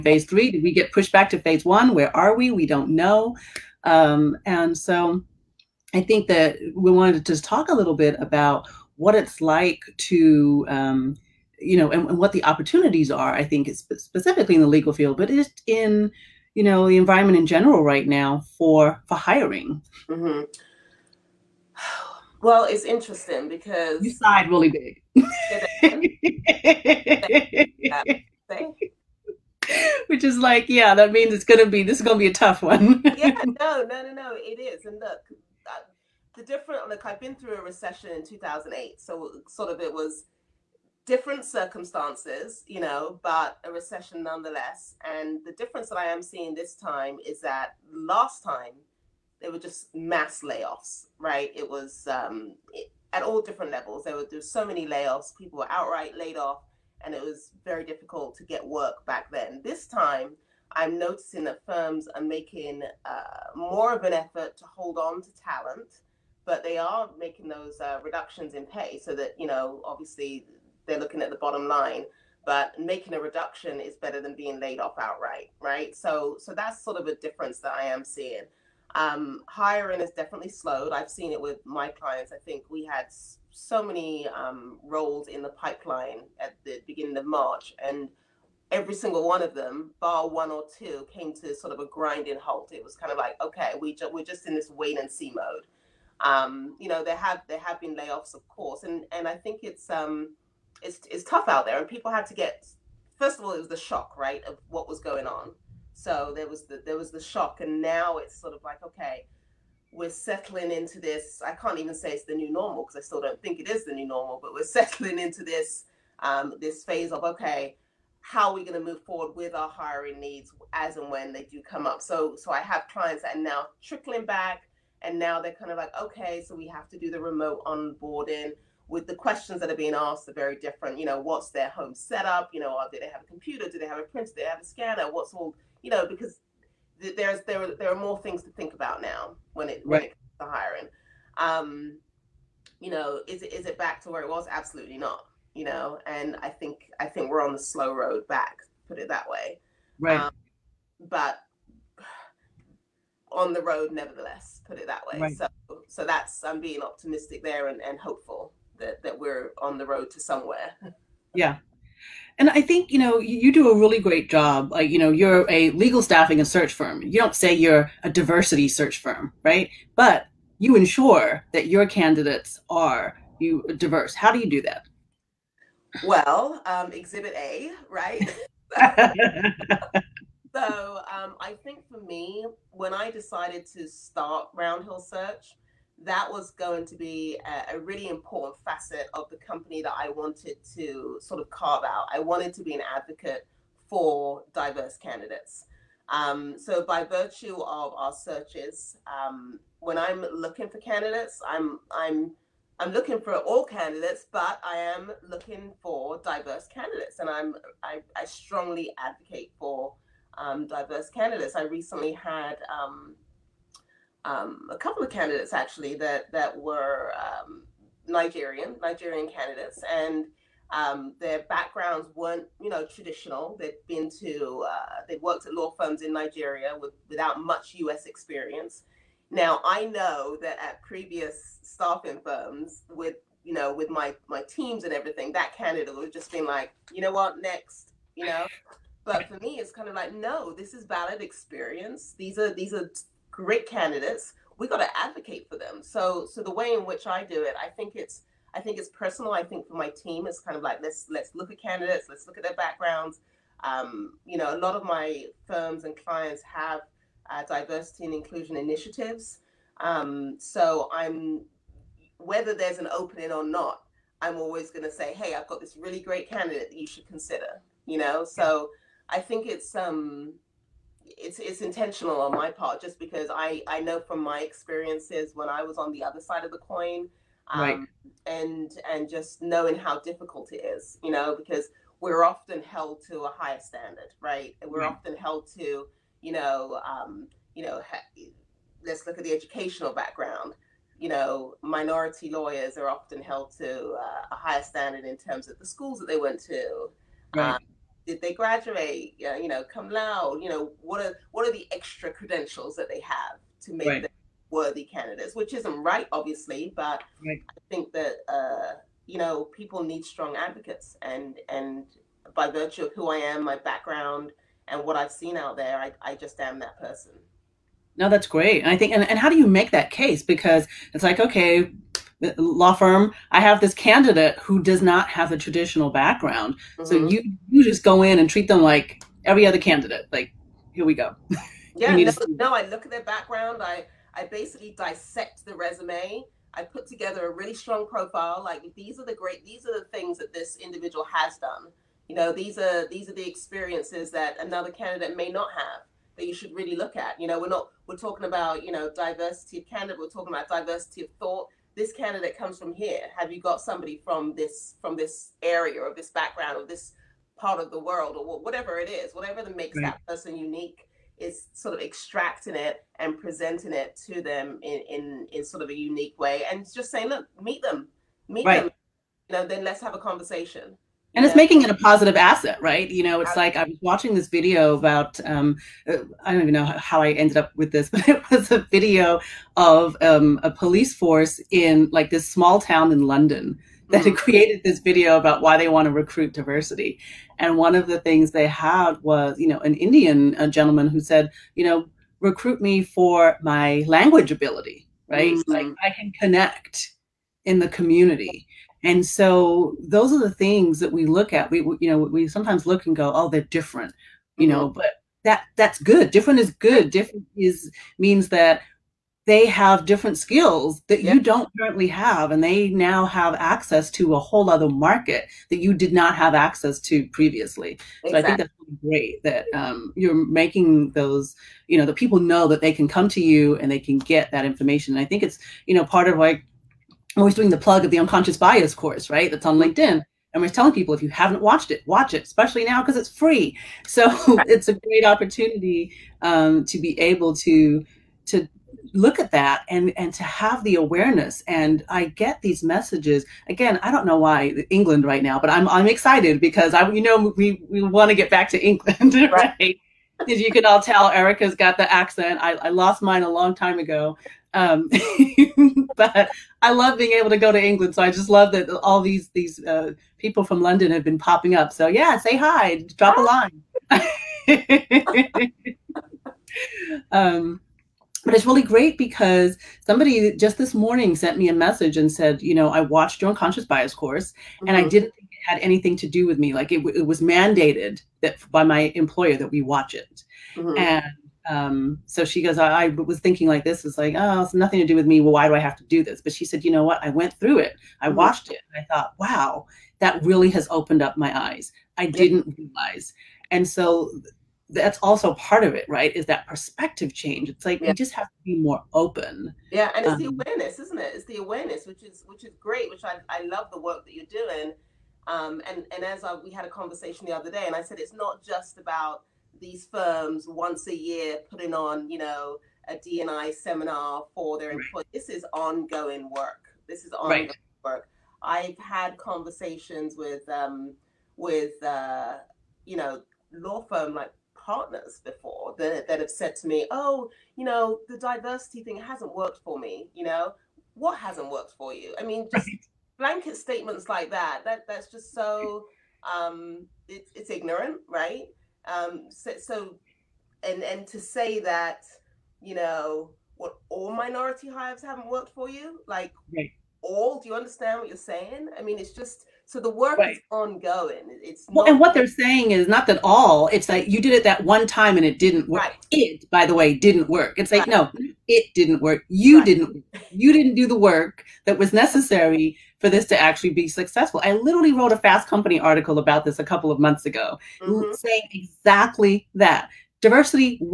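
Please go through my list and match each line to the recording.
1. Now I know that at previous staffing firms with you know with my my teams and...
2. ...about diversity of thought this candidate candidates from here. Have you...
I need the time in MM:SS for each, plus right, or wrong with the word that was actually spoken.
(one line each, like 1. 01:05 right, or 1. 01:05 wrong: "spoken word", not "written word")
1. 03:49 right
2. 05:50 wrong: "comes", not "candidates".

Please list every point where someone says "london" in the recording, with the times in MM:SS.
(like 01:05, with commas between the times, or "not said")
06:23, 07:40.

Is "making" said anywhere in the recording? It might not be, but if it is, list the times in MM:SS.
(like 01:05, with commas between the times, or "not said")
01:02, 01:07, 01:12, 06:11, 07:00.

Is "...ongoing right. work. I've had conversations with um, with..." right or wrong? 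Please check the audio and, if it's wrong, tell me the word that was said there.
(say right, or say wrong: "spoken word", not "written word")
right.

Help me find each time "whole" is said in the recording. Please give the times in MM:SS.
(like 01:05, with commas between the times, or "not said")
06:54.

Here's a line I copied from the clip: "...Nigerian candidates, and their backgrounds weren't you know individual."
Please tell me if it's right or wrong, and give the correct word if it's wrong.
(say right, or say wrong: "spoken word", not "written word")
wrong: "traditional", not "individual".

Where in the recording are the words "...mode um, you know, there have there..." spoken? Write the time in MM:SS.
01:35.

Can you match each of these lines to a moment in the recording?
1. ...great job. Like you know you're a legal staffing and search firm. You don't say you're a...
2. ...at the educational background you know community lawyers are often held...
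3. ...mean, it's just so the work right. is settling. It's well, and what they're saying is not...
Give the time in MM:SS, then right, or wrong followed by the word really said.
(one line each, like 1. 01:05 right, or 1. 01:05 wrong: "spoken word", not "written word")
1. 02:43 right
2. 04:49 wrong: "minority", not "community"
3. 09:08 wrong: "ongoing", not "settling".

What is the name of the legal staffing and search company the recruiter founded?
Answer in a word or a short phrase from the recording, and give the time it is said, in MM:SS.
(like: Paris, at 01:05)
Round Hill Search, at 03:04.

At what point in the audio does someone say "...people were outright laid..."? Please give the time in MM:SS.
00:55.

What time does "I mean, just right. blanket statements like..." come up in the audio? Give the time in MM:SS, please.
08:52.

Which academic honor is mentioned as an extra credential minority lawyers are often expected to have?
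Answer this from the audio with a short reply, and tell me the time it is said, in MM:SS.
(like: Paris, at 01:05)
cum laude, at 04:59.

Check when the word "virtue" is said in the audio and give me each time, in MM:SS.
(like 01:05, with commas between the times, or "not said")
03:17, 05:12.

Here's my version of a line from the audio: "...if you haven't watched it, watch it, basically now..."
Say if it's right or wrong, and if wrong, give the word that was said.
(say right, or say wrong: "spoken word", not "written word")
wrong: "especially", not "basically".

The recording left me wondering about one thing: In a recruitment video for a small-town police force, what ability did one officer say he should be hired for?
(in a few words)
language ability.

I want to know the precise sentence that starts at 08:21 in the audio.
It's the awareness, which is which is great.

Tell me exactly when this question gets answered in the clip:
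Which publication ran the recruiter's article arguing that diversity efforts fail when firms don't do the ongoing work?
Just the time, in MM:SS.
09:25.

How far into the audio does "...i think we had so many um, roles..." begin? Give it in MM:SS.
01:22.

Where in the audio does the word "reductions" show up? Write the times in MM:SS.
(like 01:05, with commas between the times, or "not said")
01:08, 01:13.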